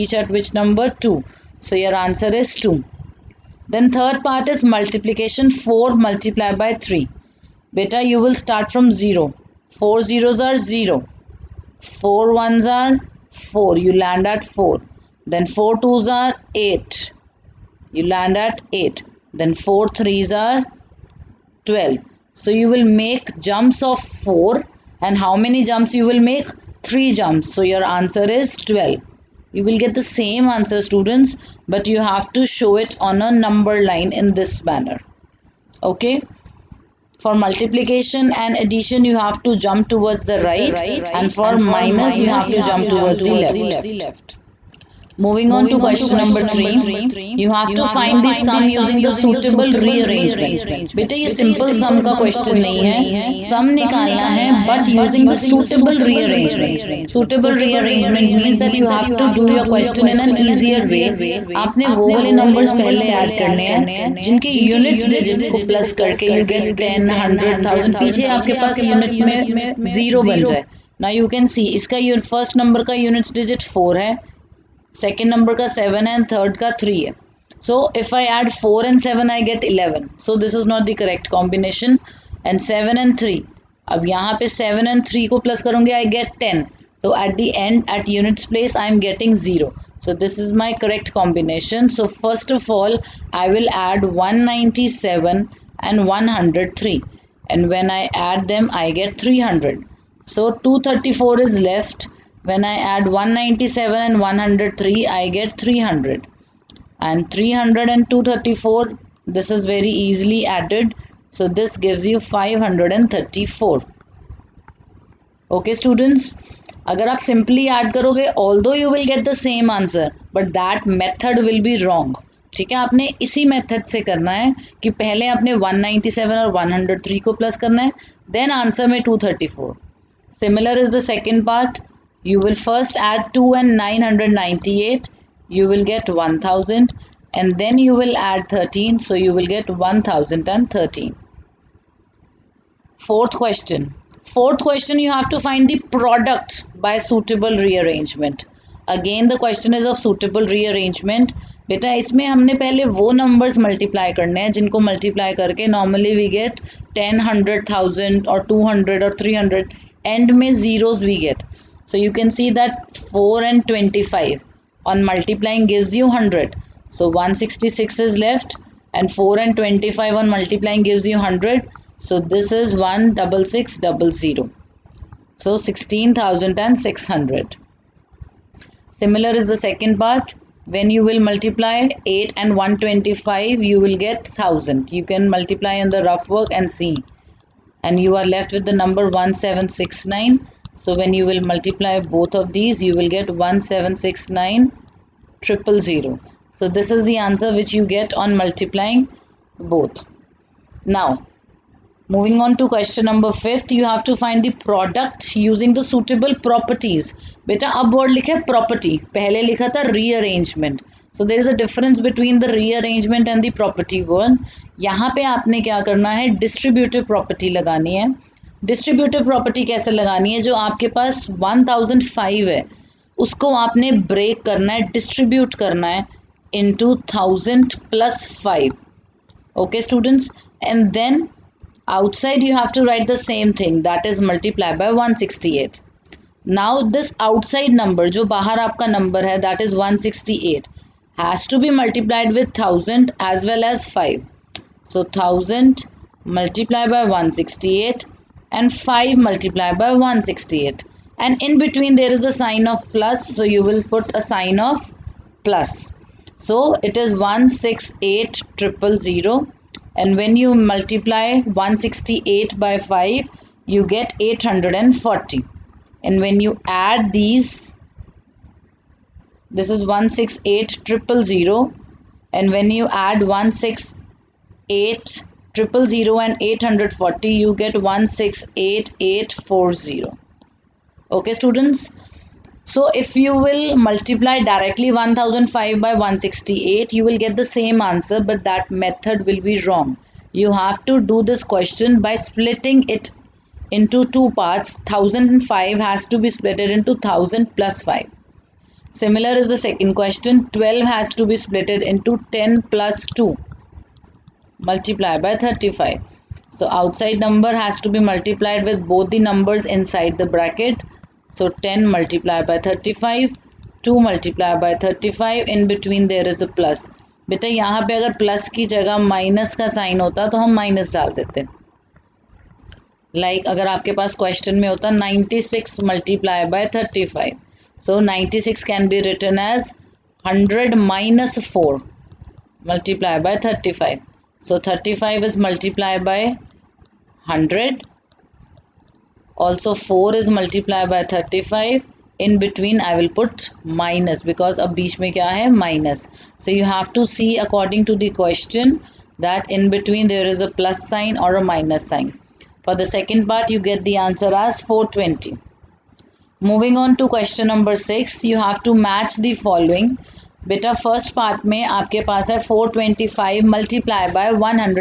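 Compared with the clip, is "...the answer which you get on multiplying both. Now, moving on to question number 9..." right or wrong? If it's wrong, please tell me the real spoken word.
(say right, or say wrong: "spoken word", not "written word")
wrong: "5", not "9".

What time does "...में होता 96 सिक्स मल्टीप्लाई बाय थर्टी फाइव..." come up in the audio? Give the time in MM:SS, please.
05:24.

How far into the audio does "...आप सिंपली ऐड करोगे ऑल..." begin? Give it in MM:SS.
01:57.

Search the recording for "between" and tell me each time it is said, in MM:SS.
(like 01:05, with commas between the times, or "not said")
03:32, 04:11, 05:15, 05:42, 05:49.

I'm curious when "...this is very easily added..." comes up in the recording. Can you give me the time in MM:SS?
01:49.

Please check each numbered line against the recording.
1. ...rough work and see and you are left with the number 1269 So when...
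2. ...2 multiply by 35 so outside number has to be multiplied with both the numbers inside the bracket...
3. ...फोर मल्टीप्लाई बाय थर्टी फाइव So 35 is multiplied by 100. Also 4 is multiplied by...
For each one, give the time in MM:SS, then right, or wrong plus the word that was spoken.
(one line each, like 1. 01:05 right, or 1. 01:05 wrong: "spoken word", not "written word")
1. 03:06 wrong: "1769", not "1269"
2. 05:03 right
3. 05:31 right.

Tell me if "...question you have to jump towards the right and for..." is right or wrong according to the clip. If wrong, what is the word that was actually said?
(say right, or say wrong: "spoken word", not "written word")
wrong: "addition", not "question".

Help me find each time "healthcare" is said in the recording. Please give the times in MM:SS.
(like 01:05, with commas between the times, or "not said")
not said.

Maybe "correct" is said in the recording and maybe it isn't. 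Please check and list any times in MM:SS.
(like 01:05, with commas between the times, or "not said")
01:20, 01:30.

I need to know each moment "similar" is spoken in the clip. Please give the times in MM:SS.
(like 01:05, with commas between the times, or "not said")
02:58, 04:59.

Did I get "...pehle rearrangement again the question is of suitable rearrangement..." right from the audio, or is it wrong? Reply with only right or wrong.
wrong.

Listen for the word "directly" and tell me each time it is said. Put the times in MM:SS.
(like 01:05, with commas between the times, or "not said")
04:44.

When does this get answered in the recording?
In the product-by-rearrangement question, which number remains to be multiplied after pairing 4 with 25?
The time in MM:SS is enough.
02:47.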